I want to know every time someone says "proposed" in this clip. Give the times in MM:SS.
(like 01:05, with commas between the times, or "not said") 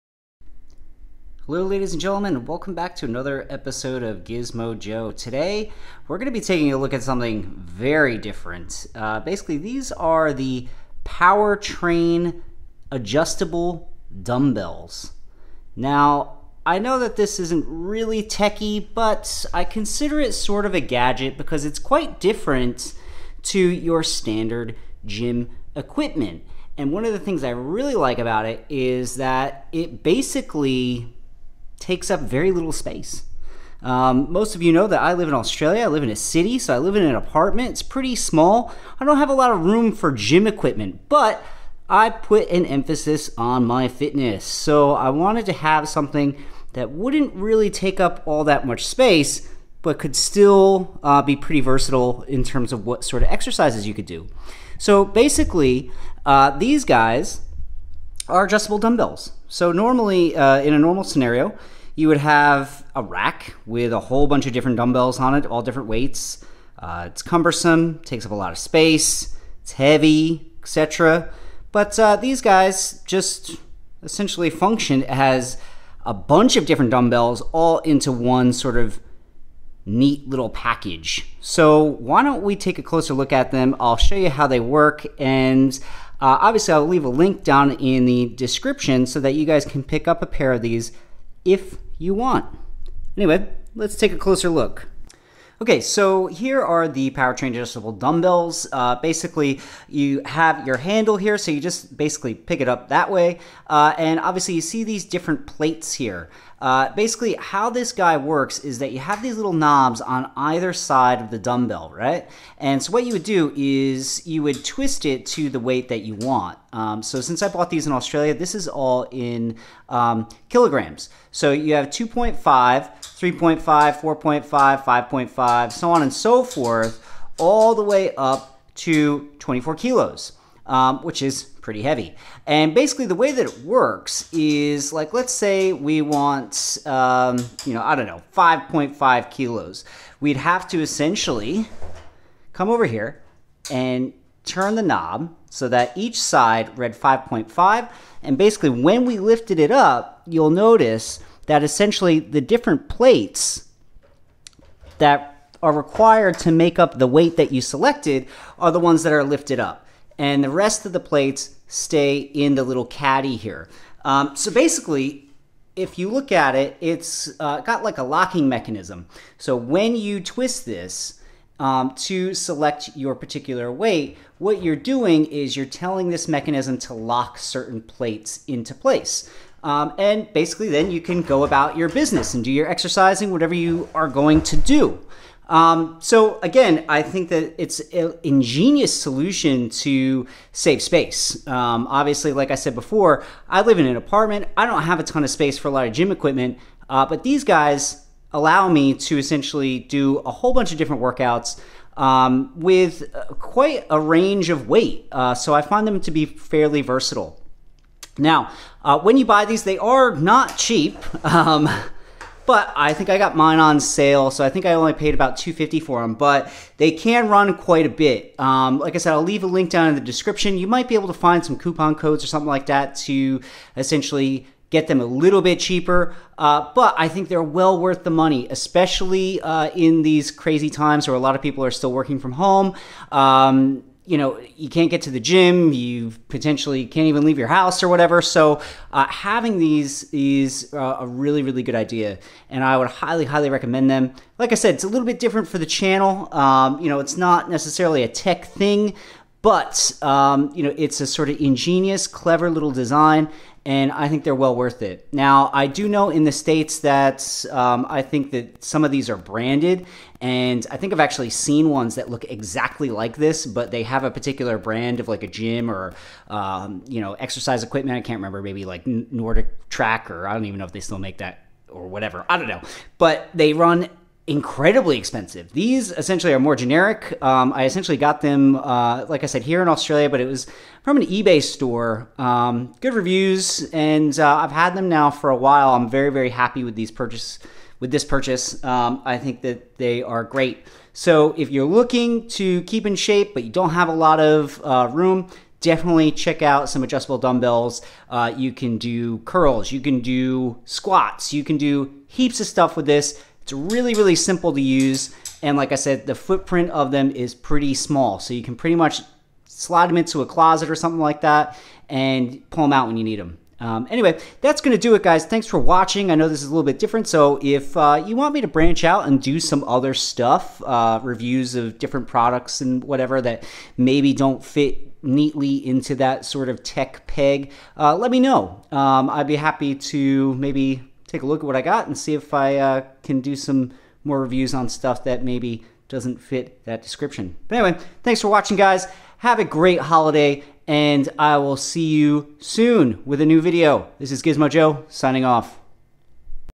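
not said.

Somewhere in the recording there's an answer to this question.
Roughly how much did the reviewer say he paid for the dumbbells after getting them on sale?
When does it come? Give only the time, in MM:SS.
03:35.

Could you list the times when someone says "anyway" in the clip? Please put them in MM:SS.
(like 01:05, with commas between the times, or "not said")
01:33, 05:13, 05:37.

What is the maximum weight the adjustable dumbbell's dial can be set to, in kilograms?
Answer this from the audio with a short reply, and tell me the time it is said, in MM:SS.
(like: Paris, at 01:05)
24 kilos, at 02:09.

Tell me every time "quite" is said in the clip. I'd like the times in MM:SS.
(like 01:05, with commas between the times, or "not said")
00:21, 03:23, 03:37.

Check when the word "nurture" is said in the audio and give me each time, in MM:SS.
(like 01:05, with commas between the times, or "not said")
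not said.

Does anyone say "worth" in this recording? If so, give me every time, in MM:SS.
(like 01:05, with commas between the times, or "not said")
03:47, 04:14.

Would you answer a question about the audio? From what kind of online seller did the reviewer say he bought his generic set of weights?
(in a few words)
An eBay store.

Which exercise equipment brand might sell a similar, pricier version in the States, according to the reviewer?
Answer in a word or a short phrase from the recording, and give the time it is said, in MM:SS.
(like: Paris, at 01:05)
Nordic Track, at 04:28.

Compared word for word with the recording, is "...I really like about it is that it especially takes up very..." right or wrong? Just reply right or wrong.
wrong.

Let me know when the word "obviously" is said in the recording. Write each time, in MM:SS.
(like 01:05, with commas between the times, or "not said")
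01:26, 01:44, 03:11.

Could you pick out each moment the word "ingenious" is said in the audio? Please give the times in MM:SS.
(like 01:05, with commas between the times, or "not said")
03:08, 04:11.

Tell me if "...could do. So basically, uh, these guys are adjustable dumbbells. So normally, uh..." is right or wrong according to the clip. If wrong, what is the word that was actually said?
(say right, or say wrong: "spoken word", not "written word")
right.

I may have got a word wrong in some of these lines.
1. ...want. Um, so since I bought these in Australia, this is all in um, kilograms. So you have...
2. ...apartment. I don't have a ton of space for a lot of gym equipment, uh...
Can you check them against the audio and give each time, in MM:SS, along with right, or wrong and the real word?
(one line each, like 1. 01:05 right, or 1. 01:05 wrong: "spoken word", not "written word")
1. 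01:56 right
2. 03:13 right.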